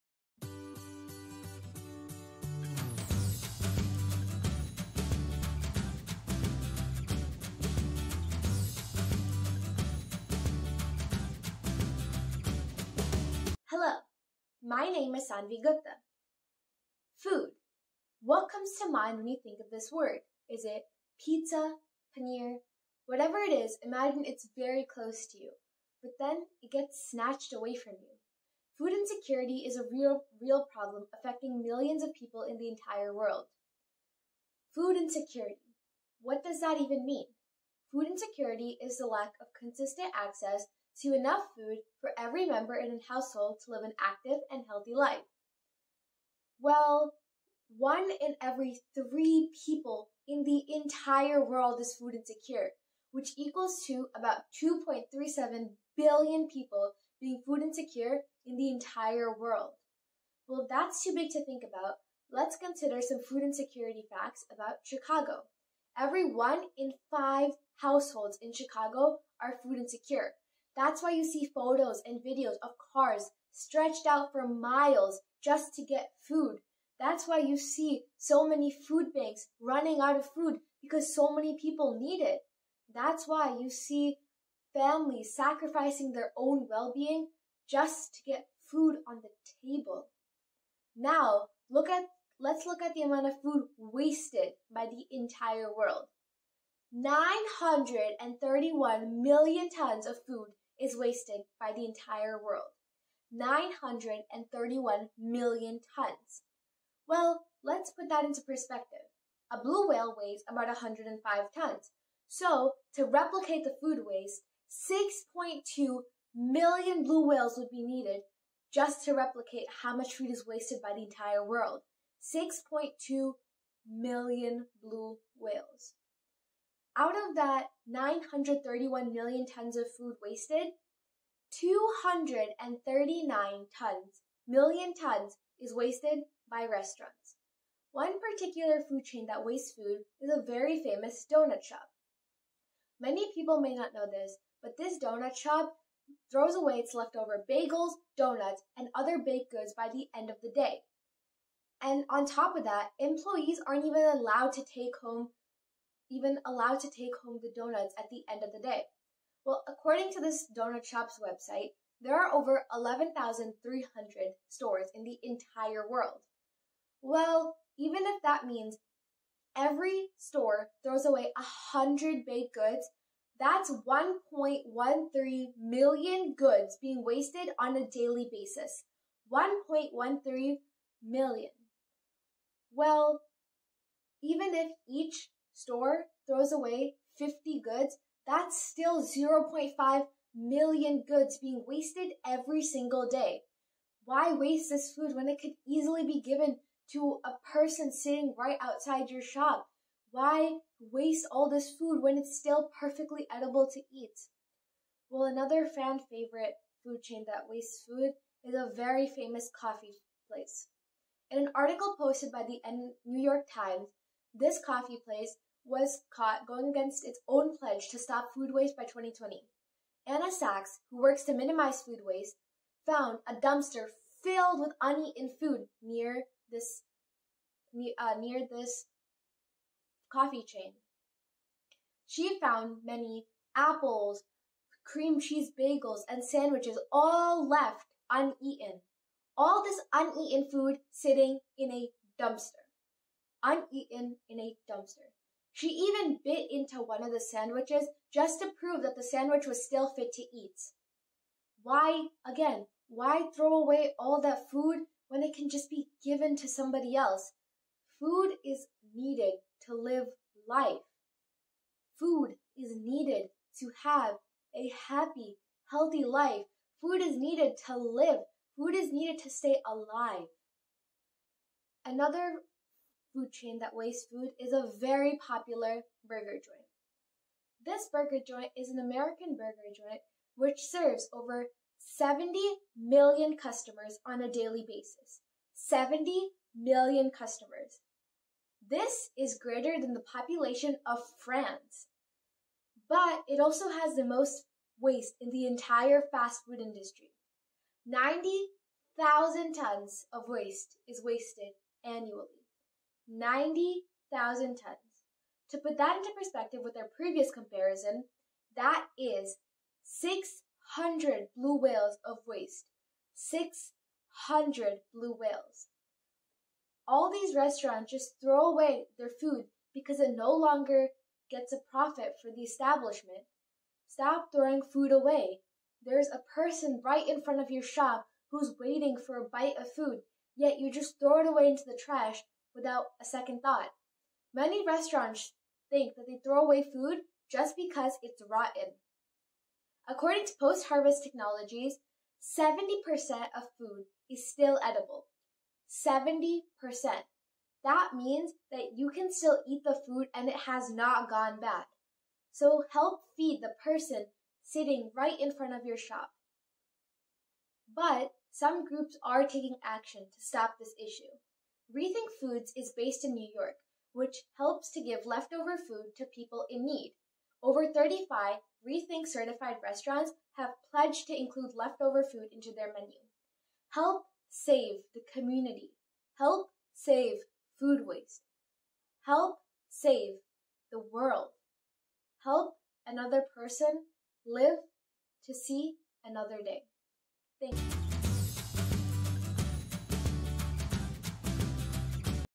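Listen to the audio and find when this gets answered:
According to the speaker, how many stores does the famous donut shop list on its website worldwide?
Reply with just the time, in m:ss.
2:42.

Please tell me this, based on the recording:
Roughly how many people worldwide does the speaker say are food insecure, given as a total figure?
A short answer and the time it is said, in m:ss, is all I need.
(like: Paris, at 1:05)
2.37 billion, at 0:54.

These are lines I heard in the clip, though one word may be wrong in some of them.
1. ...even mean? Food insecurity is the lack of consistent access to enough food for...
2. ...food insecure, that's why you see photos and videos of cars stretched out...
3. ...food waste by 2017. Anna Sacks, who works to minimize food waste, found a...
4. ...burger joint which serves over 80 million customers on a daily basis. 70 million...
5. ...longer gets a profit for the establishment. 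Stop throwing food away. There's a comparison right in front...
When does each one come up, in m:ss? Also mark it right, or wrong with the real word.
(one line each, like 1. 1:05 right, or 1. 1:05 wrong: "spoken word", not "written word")
1. 0:36 right
2. 1:09 right
3. 3:38 wrong: "2020", not "2017"
4. 4:39 wrong: "70", not "80"
5. 5:20 wrong: "person", not "comparison".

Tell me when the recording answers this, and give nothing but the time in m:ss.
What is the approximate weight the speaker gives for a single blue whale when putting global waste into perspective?
1:50.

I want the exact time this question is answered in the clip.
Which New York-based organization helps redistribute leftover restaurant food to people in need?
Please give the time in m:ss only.
6:01.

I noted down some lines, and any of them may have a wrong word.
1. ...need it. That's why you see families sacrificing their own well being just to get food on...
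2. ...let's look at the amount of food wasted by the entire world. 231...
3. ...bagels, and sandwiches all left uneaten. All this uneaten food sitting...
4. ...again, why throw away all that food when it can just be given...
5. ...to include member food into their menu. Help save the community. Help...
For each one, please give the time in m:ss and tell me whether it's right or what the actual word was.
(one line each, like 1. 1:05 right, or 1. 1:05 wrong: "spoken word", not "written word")
1. 1:22 right
2. 1:32 wrong: "931", not "231"
3. 3:55 right
4. 4:12 right
5. 6:11 wrong: "leftover", not "member".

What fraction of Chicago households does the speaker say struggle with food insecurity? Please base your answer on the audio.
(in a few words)
1 in 5.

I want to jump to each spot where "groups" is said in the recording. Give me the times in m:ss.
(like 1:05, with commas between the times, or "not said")
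5:58.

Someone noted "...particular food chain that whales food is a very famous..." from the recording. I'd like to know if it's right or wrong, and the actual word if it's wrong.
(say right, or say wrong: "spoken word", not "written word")
wrong: "wastes", not "whales".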